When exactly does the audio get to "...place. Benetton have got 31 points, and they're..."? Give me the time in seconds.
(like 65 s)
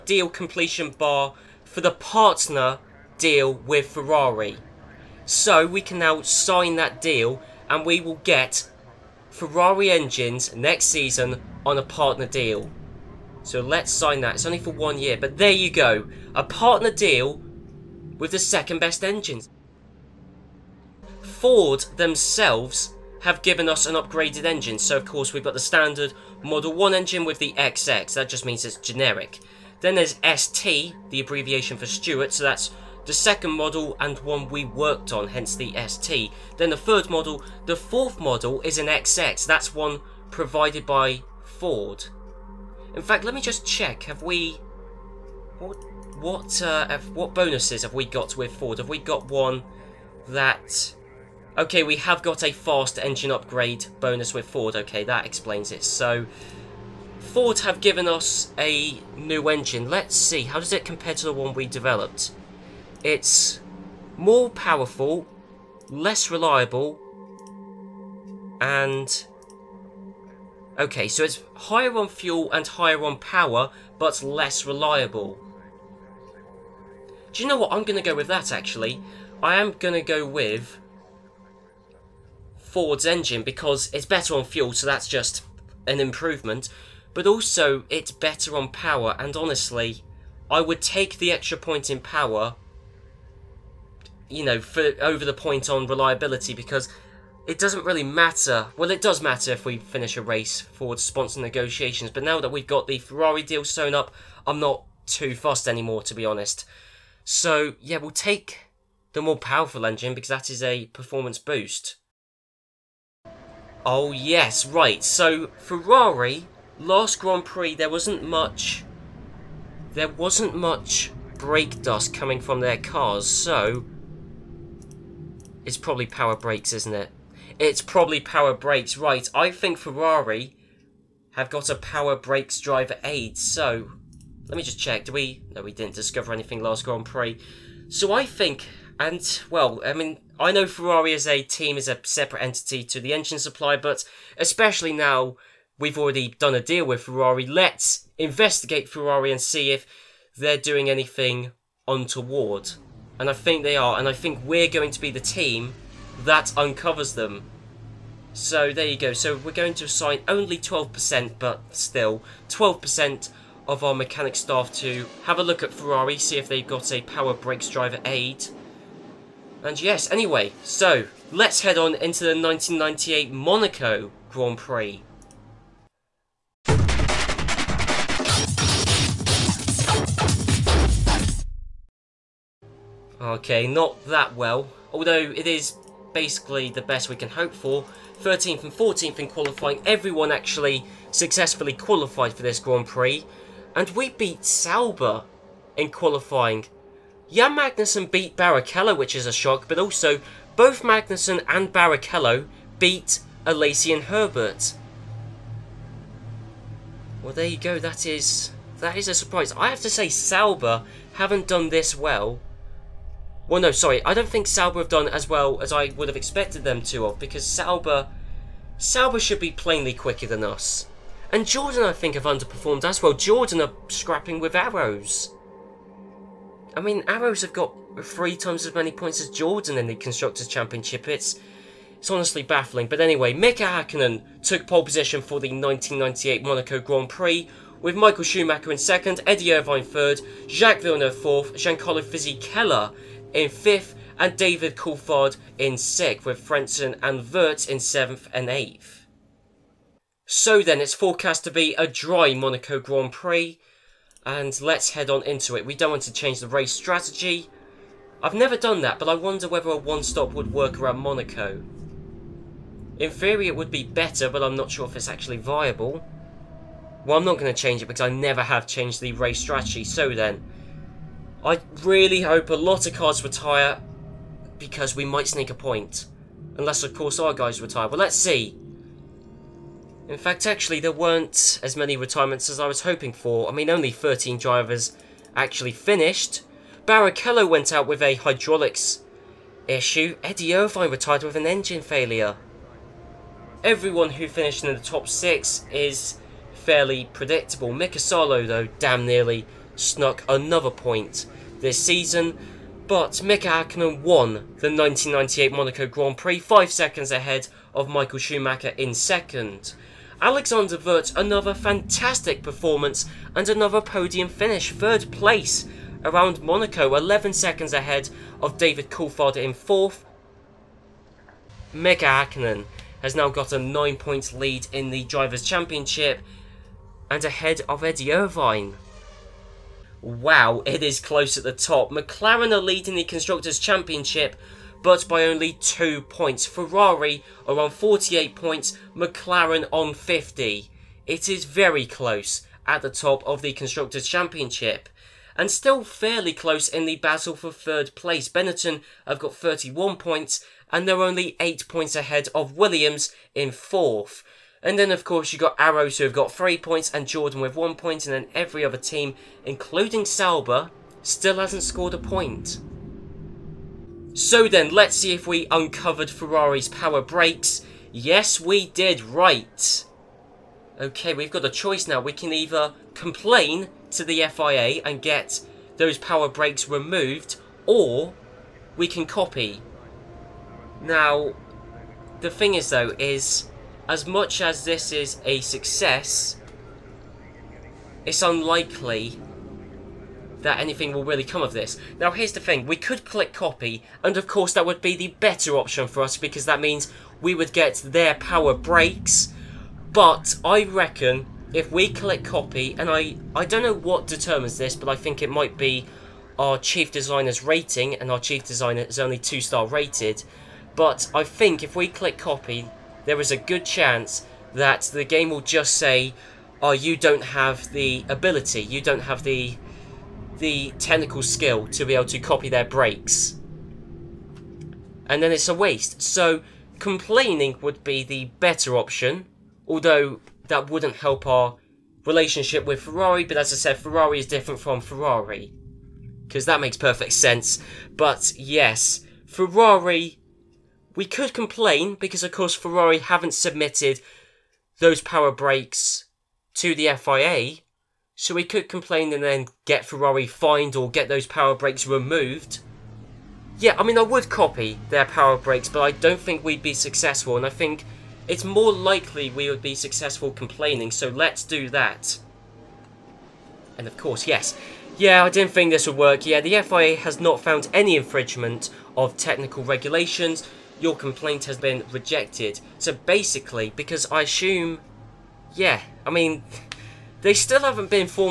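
347 s.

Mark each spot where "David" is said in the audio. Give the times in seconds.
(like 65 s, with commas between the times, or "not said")
244 s, 318 s.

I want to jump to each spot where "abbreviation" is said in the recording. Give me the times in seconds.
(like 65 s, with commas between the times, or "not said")
31 s.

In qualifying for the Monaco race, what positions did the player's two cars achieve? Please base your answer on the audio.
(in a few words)
13th and 14th.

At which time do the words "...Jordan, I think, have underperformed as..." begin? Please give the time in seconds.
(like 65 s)
221 s.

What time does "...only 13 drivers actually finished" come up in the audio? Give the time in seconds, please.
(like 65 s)
283 s.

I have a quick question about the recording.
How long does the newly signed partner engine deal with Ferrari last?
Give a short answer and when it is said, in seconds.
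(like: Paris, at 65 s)
1 year, at 14 s.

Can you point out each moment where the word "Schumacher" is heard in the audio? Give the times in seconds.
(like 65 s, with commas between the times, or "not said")
238 s, 308 s.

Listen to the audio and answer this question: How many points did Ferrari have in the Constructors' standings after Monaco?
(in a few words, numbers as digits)
48.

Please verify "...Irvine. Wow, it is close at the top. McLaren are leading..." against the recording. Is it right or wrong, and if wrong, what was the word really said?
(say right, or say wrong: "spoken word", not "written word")
right.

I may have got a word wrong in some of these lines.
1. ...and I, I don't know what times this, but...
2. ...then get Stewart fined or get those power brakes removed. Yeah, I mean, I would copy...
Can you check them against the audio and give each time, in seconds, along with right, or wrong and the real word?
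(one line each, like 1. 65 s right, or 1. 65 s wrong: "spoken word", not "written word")
1. 402 s wrong: "determines", not "times"
2. 449 s wrong: "Ferrari", not "Stewart".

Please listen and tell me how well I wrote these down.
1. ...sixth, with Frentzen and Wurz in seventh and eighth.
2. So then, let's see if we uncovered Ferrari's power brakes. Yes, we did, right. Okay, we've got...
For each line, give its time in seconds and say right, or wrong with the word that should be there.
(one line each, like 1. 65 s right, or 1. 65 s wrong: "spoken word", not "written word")
1. 245 s right
2. 364 s right.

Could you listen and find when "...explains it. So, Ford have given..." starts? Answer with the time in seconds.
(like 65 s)
55 s.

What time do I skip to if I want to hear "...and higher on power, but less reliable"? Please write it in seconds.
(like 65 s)
72 s.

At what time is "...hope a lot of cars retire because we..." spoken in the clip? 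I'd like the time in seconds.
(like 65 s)
272 s.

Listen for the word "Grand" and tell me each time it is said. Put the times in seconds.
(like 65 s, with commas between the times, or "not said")
117 s, 136 s, 174 s, 192 s, 236 s, 252 s, 305 s.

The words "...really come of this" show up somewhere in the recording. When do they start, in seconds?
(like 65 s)
391 s.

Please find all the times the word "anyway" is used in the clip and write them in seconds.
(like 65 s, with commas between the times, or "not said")
170 s, 233 s.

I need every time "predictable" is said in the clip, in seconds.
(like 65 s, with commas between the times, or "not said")
297 s.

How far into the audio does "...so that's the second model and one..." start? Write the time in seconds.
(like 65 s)
32 s.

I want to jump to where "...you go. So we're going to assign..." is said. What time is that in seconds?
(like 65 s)
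158 s.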